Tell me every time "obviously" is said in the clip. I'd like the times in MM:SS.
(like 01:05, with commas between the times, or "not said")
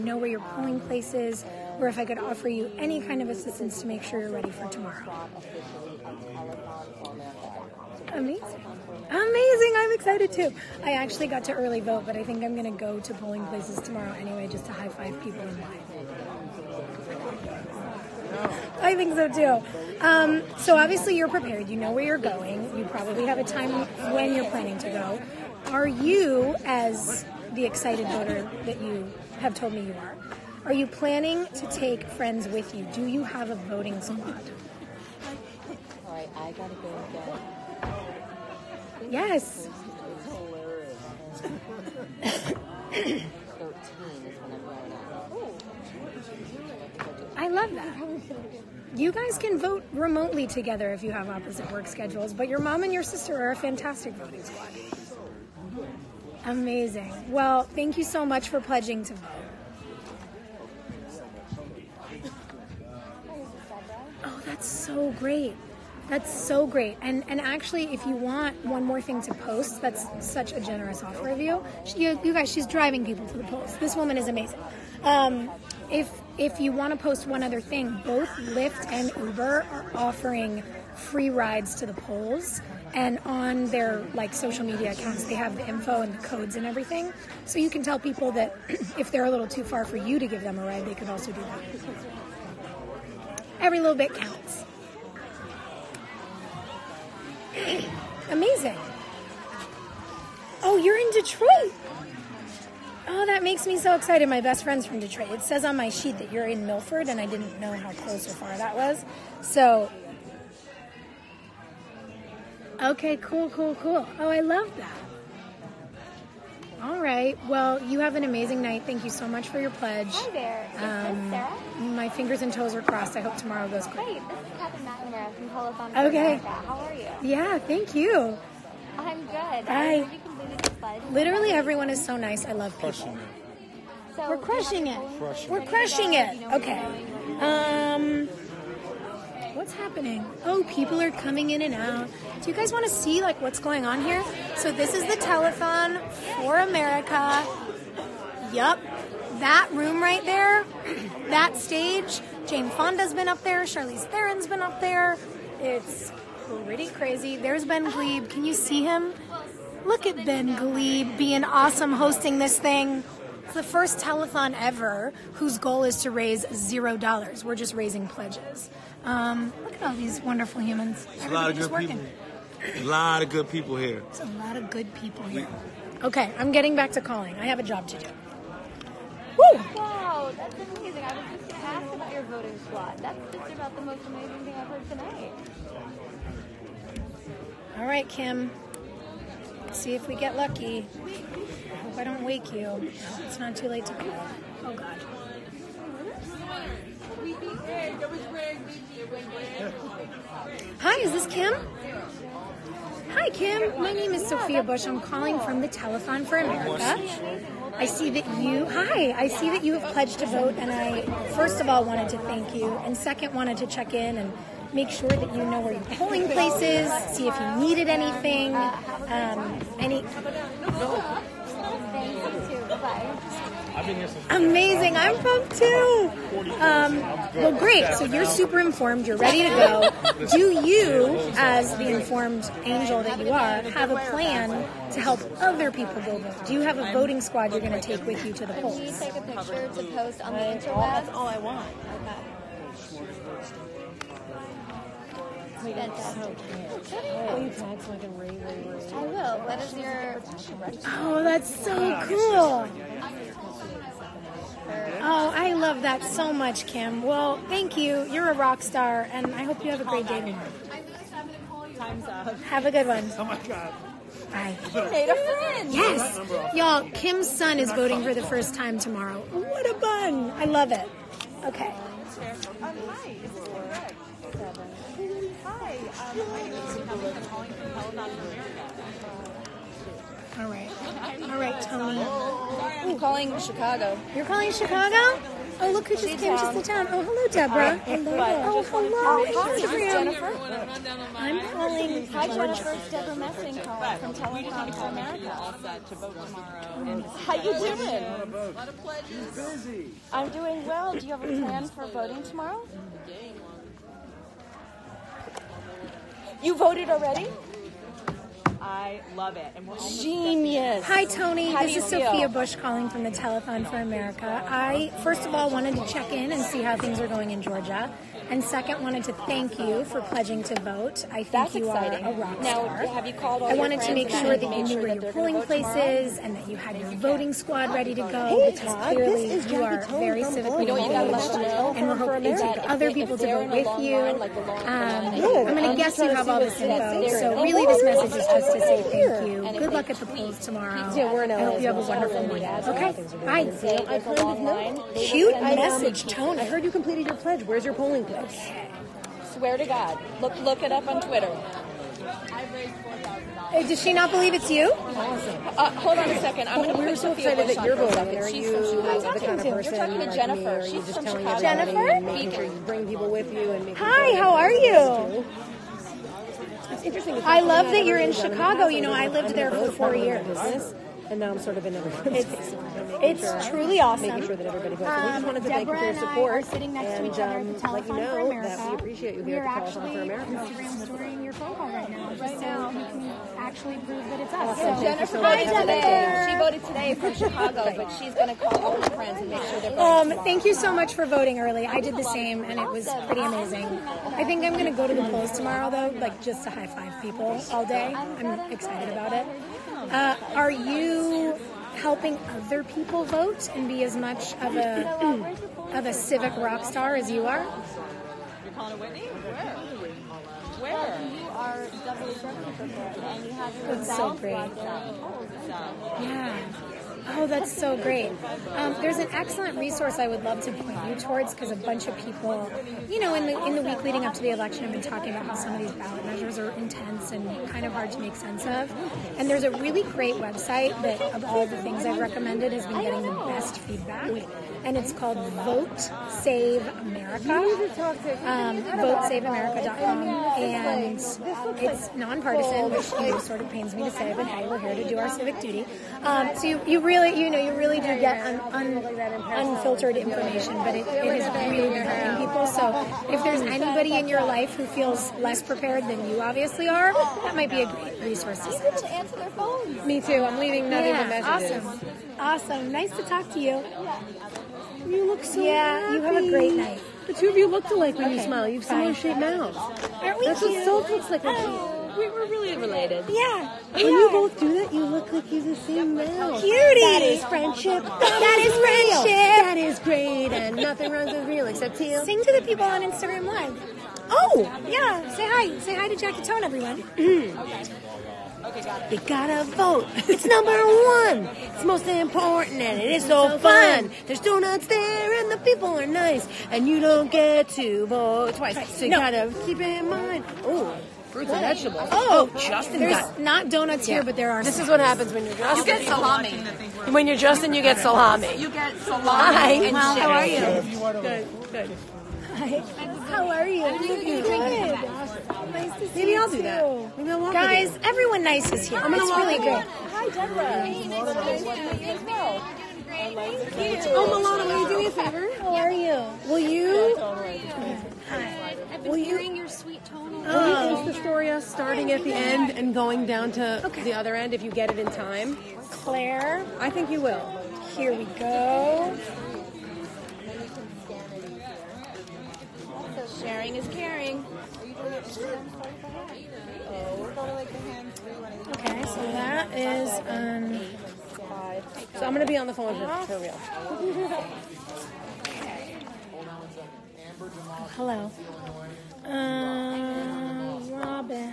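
00:20, 07:36.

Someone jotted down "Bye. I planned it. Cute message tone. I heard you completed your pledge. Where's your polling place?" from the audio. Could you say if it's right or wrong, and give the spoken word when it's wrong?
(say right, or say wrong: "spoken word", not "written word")
right.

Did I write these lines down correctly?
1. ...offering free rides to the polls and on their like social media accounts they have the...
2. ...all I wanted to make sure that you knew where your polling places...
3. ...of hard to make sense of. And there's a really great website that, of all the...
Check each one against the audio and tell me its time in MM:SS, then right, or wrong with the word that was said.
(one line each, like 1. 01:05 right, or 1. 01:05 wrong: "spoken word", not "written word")
1. 01:19 right
2. 05:23 right
3. 07:07 right.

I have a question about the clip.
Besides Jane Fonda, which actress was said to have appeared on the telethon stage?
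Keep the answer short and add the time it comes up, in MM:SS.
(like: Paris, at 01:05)
Charlize Theron, at 02:33.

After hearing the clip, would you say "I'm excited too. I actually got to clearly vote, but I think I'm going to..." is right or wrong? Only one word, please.
wrong.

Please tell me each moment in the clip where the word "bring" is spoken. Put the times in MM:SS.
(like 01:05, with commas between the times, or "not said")
06:02, 08:49.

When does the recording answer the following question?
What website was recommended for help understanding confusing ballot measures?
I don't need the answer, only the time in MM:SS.
07:18.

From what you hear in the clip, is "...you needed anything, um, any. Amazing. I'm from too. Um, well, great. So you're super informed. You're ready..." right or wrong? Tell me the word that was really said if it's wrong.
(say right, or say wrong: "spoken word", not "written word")
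right.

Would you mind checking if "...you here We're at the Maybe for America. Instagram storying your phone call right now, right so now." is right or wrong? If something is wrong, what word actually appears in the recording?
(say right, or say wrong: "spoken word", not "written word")
wrong: "Telethon", not "Maybe".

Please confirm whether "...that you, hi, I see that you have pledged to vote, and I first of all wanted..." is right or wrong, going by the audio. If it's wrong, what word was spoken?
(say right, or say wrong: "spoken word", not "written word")
right.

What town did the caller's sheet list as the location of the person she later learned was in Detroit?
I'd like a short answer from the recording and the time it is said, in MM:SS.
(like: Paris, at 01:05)
Milford, at 01:46.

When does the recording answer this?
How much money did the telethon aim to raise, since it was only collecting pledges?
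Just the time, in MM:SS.
02:46.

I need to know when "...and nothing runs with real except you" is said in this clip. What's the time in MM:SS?
08:00.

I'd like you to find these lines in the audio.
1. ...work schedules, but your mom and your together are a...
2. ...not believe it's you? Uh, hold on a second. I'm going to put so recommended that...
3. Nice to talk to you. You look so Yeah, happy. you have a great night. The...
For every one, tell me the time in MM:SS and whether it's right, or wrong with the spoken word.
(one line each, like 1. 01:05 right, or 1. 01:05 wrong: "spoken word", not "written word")
1. 00:51 wrong: "sister", not "together"
2. 05:53 wrong: "excited", not "recommended"
3. 07:42 right.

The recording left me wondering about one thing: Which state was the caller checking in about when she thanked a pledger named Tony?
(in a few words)
Georgia.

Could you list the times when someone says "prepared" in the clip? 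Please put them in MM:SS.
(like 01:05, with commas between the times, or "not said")
00:21, 07:35.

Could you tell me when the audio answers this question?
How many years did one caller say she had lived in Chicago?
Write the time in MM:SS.
06:09.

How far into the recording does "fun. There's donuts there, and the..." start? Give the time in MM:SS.
08:13.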